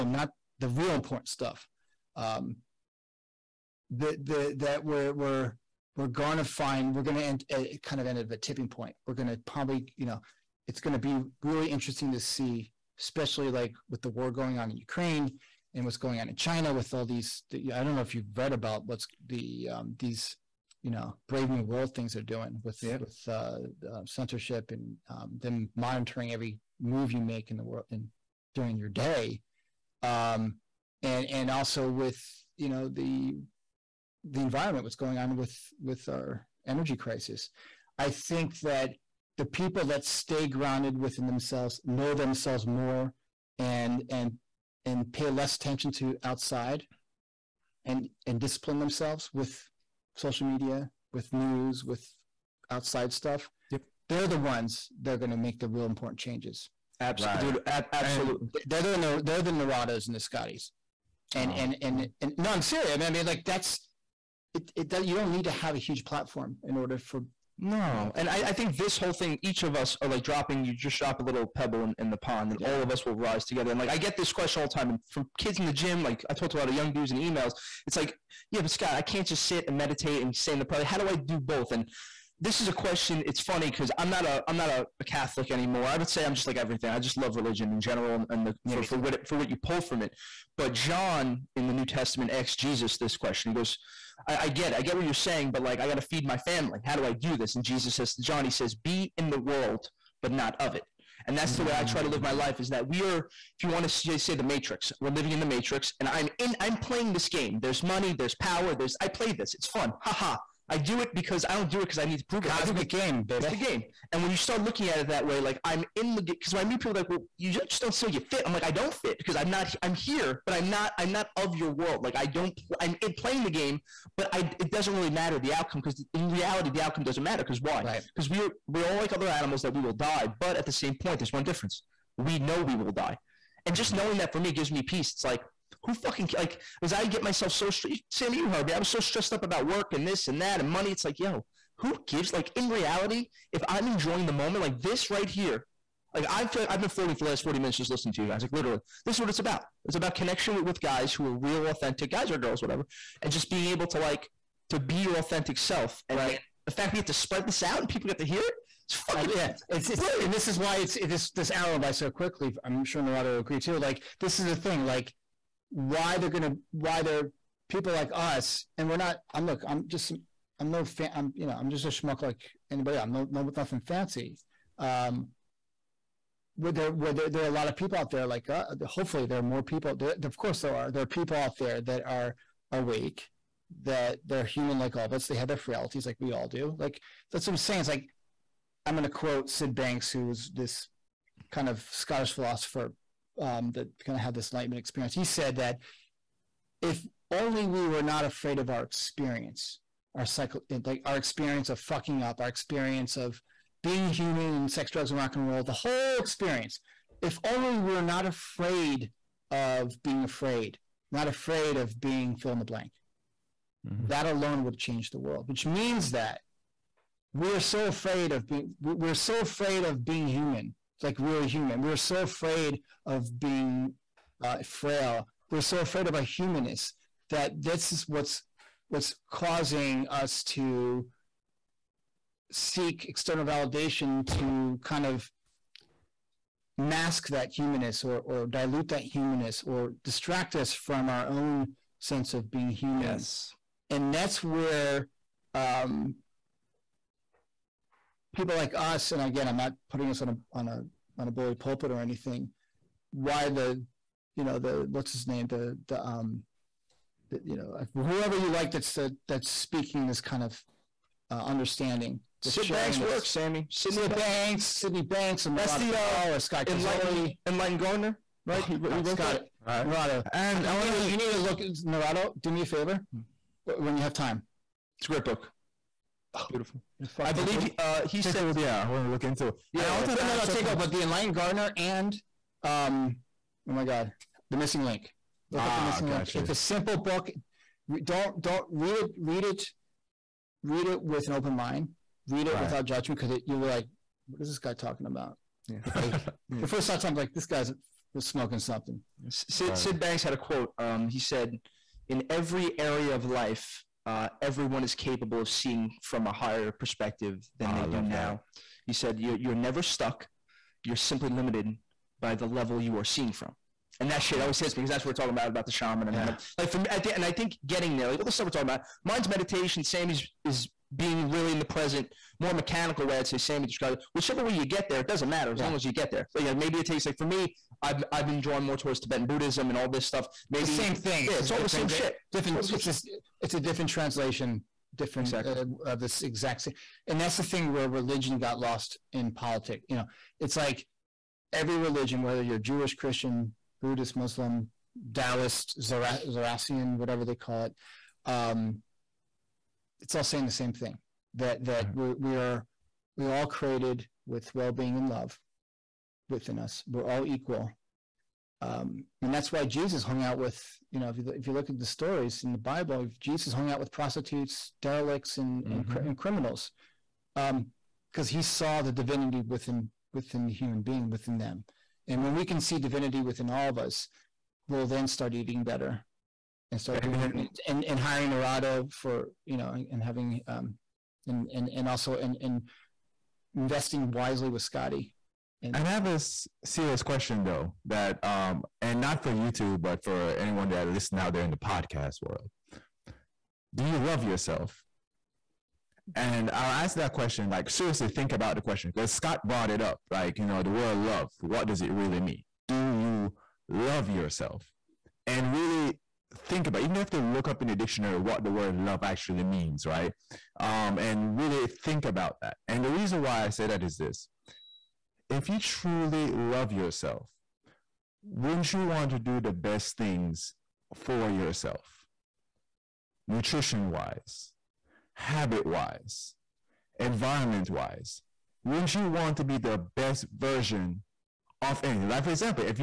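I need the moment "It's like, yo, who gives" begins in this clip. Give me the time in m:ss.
2:20.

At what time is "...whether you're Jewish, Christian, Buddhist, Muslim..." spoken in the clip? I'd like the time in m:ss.
5:42.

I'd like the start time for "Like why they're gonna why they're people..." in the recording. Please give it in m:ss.
2:44.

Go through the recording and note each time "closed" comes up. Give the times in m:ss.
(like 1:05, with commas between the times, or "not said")
not said.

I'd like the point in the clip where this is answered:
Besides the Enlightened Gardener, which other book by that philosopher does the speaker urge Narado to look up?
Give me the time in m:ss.
4:44.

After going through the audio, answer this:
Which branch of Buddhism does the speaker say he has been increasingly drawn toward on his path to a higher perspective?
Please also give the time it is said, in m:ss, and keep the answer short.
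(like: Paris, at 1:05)
Tibetan Buddhism, at 5:29.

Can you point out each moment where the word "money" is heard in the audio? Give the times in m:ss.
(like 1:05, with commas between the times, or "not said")
1:47, 2:20.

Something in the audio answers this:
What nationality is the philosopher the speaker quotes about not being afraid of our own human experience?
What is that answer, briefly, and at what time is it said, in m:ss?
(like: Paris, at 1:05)
Scottish, at 3:11.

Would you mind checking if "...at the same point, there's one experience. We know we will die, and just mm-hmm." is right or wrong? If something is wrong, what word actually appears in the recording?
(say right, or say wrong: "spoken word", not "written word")
wrong: "difference", not "experience".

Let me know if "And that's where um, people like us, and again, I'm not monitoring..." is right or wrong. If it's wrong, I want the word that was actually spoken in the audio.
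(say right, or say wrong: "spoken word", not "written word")
wrong: "putting", not "monitoring".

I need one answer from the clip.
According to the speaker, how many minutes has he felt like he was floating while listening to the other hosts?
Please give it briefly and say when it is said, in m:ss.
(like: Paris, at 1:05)
40, at 2:27.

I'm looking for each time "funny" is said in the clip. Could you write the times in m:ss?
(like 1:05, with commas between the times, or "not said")
1:23.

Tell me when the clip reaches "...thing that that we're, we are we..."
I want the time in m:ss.
5:50.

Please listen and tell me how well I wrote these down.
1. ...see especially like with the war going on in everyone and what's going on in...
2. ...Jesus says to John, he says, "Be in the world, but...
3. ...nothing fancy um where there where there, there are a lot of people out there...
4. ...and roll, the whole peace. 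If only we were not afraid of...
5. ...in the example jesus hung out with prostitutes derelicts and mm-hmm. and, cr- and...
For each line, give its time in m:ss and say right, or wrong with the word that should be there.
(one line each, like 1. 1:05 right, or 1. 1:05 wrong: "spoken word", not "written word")
1. 0:12 wrong: "ukraine", not "everyone"
2. 1:37 right
3. 2:53 right
4. 3:25 wrong: "experience", not "peace"
5. 6:02 wrong: "bible", not "example".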